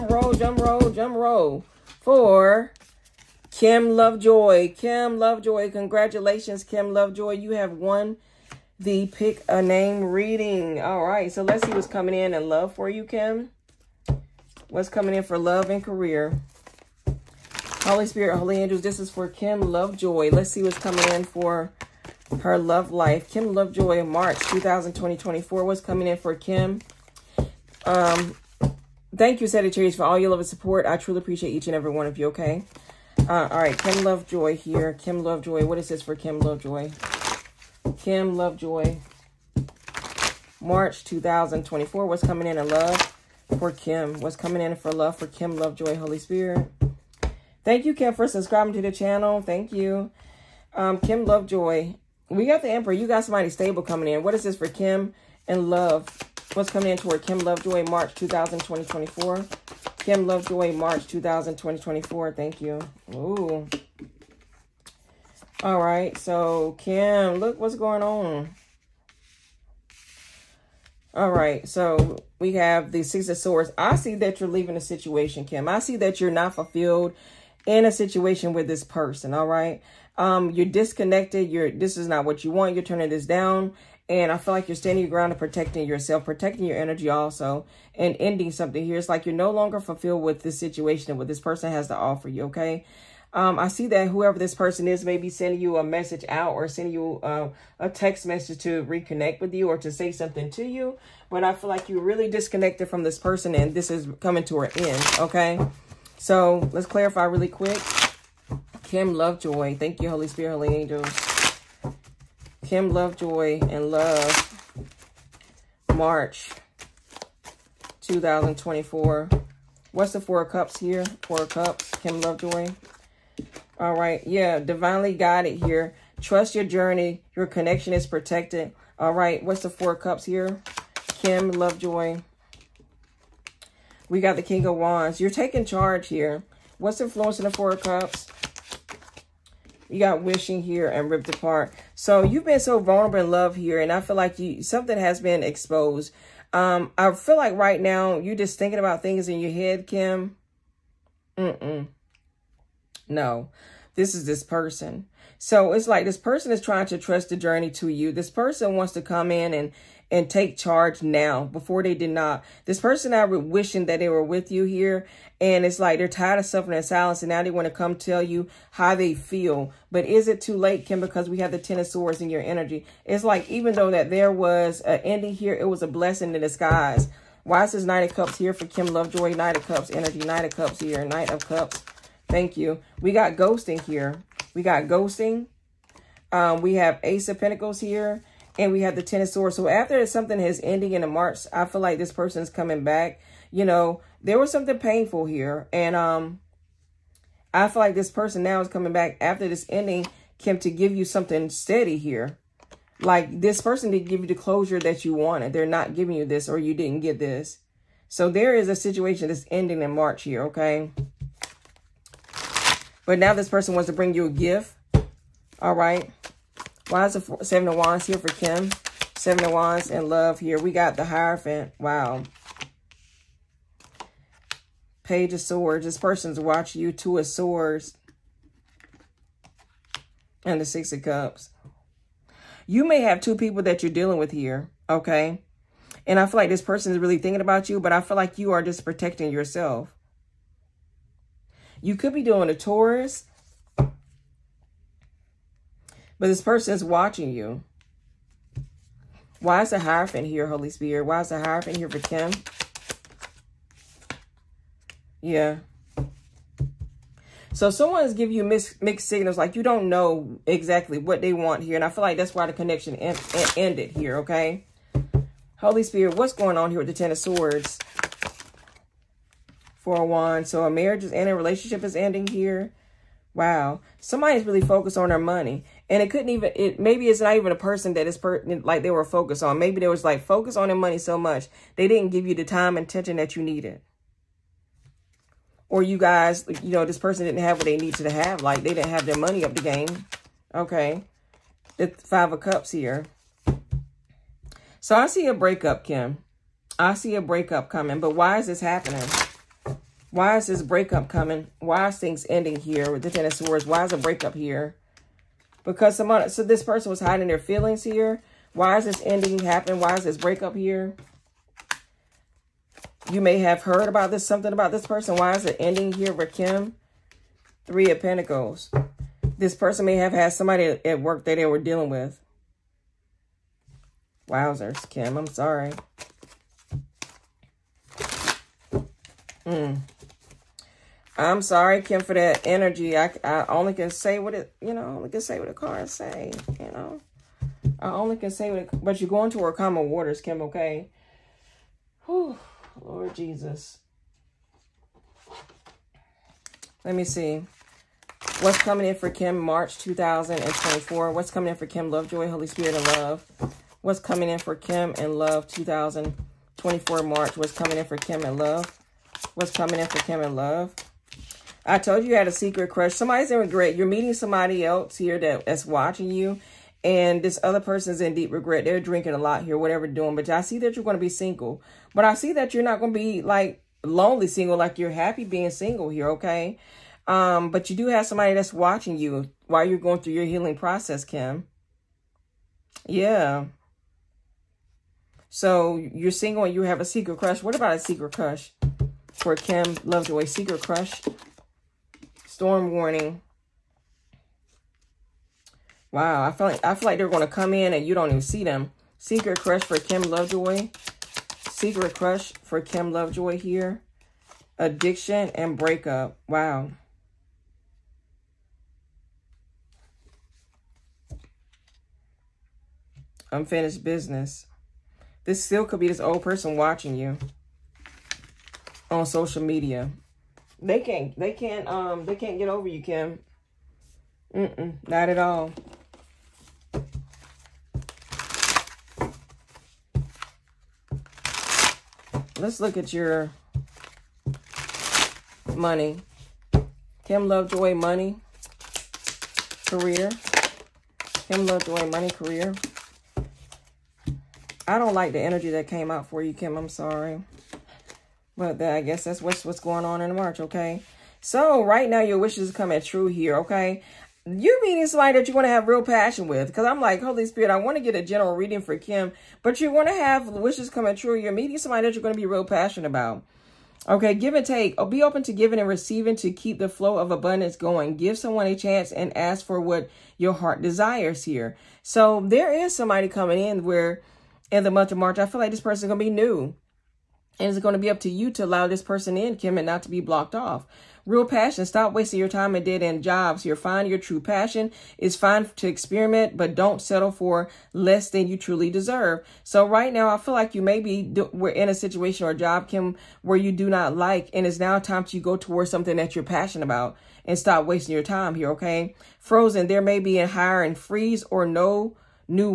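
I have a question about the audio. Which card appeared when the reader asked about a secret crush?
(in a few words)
Storm Warning.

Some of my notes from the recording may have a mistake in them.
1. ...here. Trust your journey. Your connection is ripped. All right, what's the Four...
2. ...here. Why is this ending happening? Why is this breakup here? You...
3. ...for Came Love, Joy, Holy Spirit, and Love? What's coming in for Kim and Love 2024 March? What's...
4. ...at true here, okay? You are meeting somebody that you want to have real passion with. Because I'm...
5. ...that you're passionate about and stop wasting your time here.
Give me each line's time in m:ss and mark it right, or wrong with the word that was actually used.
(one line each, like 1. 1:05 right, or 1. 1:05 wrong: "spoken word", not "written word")
1. 2:05 wrong: "protected", not "ripped"
2. 5:07 right
3. 5:51 wrong: "Kim", not "Came"
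4. 7:32 right
5. 8:15 right.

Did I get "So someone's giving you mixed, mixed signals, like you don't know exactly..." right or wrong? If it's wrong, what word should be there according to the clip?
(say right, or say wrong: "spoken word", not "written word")
right.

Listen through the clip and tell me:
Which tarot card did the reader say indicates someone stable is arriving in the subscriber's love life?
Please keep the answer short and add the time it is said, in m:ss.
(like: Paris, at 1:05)
The Emperor, at 0:52.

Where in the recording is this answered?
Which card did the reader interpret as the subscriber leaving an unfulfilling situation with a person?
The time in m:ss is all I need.
1:13.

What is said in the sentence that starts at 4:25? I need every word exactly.
Holy Spirit, what's going on here with the Ten of Swords?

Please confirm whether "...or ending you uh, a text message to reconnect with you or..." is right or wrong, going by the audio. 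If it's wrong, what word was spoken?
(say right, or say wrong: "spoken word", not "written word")
wrong: "sending", not "ending".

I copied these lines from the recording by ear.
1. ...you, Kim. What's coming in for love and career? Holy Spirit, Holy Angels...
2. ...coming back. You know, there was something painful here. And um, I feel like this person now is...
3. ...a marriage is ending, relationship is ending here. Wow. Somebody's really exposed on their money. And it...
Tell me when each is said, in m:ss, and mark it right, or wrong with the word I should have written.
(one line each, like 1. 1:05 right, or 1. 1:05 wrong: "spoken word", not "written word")
1. 0:12 right
2. 3:12 right
3. 4:30 wrong: "focused", not "exposed".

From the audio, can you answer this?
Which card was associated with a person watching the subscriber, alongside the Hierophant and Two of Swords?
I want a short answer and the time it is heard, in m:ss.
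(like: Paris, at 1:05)
Page of Swords, at 3:45.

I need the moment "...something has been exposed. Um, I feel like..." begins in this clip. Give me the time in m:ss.
2:24.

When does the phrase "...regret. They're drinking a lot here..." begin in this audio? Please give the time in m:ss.
6:08.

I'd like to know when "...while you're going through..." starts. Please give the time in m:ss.
6:19.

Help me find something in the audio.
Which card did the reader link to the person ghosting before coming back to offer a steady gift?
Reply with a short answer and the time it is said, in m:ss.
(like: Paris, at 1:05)
Ace of Pentacles, at 3:07.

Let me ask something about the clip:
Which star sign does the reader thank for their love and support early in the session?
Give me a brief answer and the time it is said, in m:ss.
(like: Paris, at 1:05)
Sagittarius, at 0:29.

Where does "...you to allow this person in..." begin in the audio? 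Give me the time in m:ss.
7:58.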